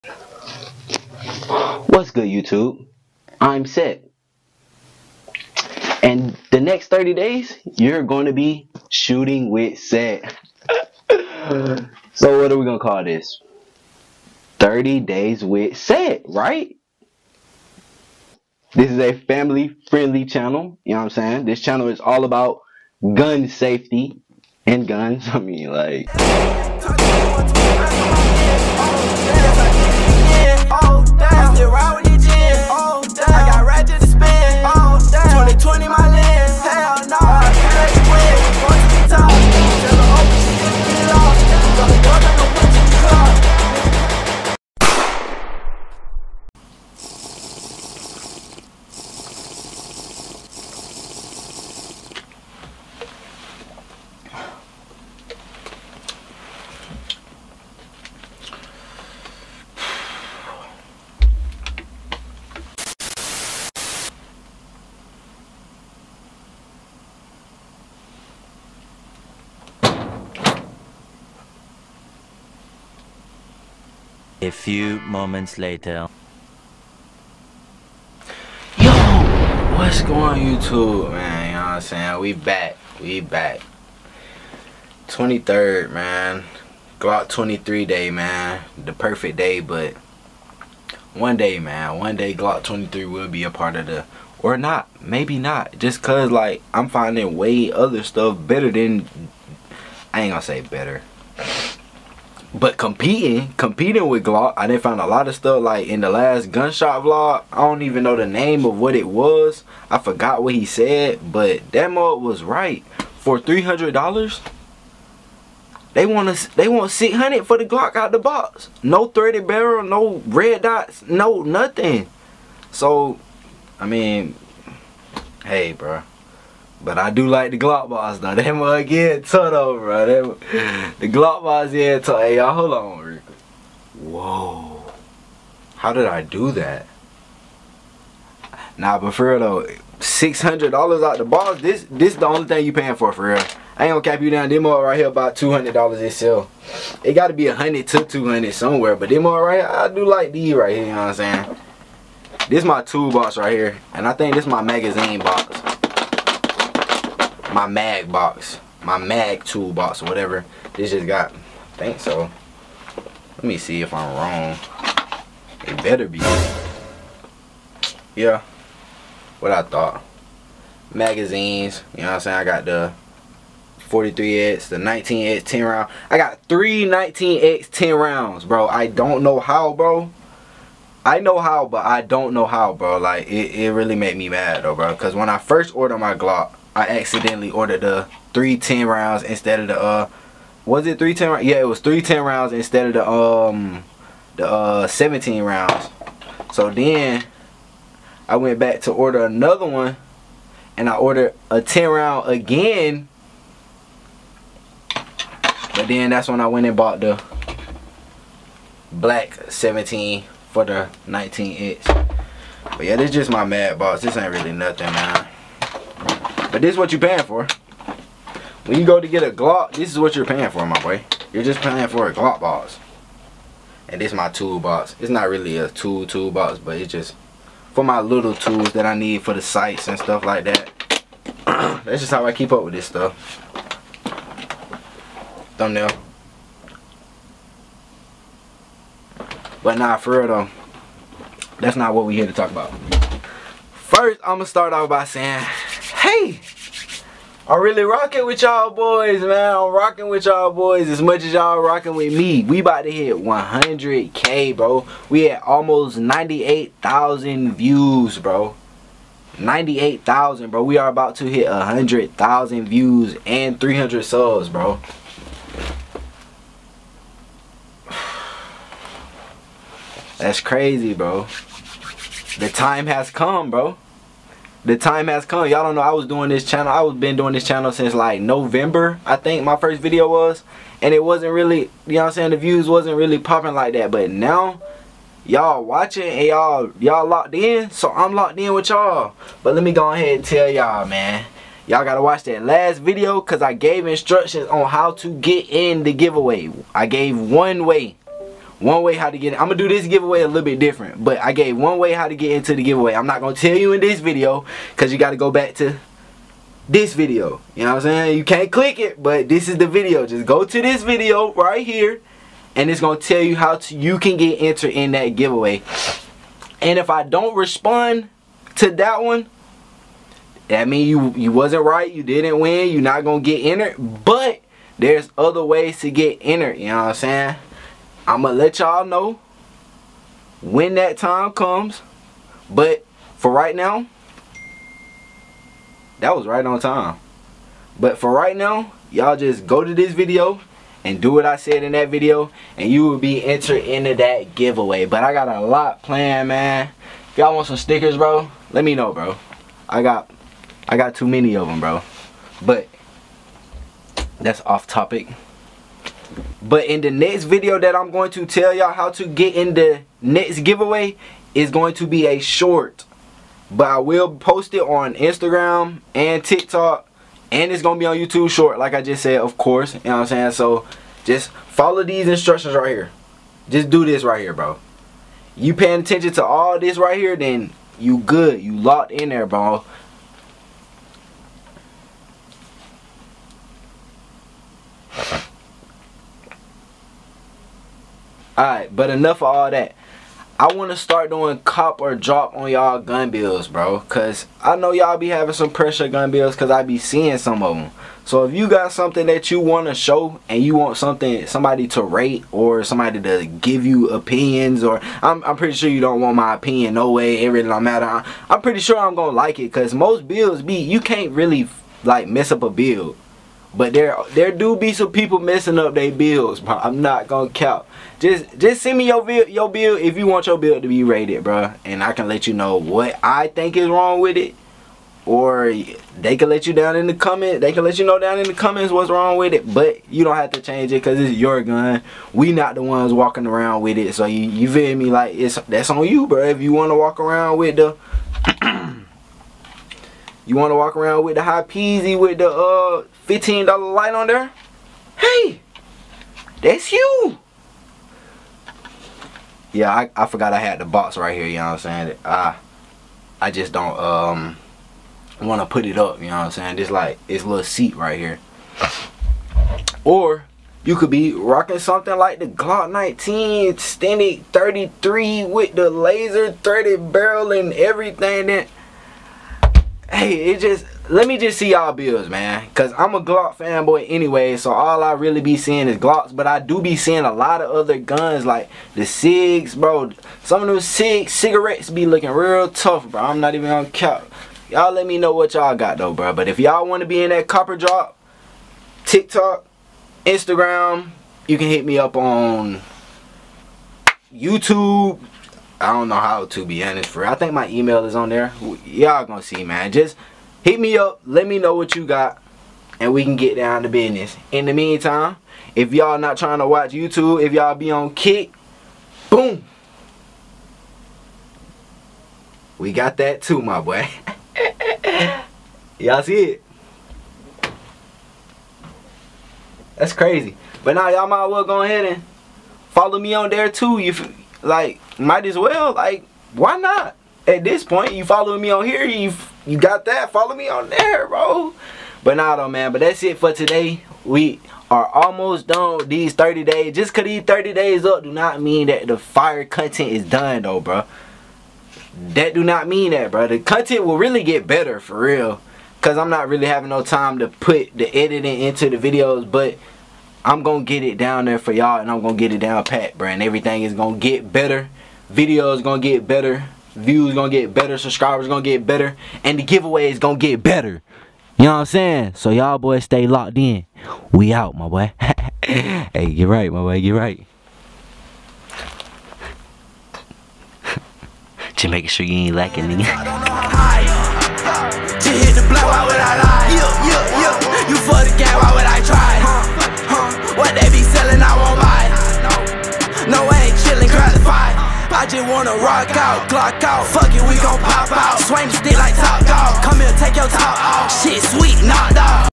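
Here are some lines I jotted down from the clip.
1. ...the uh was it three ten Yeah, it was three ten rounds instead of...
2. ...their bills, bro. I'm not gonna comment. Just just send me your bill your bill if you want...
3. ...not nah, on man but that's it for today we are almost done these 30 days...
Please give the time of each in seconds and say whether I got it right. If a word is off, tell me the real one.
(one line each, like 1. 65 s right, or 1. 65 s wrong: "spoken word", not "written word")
1. 189 s right
2. 415 s wrong: "count", not "comment"
3. 532 s right.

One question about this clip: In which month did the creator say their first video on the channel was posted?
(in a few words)
November.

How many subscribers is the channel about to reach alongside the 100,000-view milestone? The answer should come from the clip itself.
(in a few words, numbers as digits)
300.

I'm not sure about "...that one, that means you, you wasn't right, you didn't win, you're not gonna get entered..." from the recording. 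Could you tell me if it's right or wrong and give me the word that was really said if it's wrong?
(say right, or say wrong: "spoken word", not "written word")
right.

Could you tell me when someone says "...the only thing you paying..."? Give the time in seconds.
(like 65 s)
142 s.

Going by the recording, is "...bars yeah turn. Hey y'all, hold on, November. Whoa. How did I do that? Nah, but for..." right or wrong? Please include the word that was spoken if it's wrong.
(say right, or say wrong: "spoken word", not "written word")
wrong: "Rick", not "November".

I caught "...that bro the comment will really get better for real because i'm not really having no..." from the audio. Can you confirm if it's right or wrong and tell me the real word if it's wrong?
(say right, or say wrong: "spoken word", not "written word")
wrong: "content", not "comment".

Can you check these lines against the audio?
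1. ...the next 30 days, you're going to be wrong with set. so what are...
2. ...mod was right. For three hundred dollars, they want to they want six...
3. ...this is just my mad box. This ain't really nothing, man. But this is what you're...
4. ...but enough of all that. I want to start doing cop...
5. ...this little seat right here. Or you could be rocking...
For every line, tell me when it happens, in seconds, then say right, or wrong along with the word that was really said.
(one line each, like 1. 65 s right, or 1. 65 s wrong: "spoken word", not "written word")
1. 6 s wrong: "shooting", not "wrong"
2. 111 s right
3. 212 s right
4. 388 s right
5. 457 s right.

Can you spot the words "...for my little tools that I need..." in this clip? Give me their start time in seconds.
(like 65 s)
227 s.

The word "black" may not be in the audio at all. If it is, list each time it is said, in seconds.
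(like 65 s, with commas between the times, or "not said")
208 s.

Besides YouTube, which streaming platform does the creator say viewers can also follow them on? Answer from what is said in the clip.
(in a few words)
Kick.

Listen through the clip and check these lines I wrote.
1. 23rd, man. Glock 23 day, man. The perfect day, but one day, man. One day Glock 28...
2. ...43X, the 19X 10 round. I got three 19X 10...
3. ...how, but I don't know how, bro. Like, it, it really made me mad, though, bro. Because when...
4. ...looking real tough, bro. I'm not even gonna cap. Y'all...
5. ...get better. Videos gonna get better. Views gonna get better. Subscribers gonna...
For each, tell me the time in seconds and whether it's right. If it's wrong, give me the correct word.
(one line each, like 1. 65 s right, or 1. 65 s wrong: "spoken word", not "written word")
1. 85 s wrong: "23", not "28"
2. 173 s right
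3. 181 s right
4. 481 s right
5. 553 s right.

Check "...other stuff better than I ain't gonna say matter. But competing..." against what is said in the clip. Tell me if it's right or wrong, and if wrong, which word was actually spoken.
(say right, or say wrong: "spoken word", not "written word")
wrong: "better", not "matter".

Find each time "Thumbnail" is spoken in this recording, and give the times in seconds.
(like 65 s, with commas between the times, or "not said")
235 s.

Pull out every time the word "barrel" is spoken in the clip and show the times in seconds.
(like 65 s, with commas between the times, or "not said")
119 s, 466 s.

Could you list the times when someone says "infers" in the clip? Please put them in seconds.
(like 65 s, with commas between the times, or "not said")
not said.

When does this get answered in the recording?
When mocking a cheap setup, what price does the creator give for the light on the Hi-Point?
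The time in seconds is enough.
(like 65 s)
443 s.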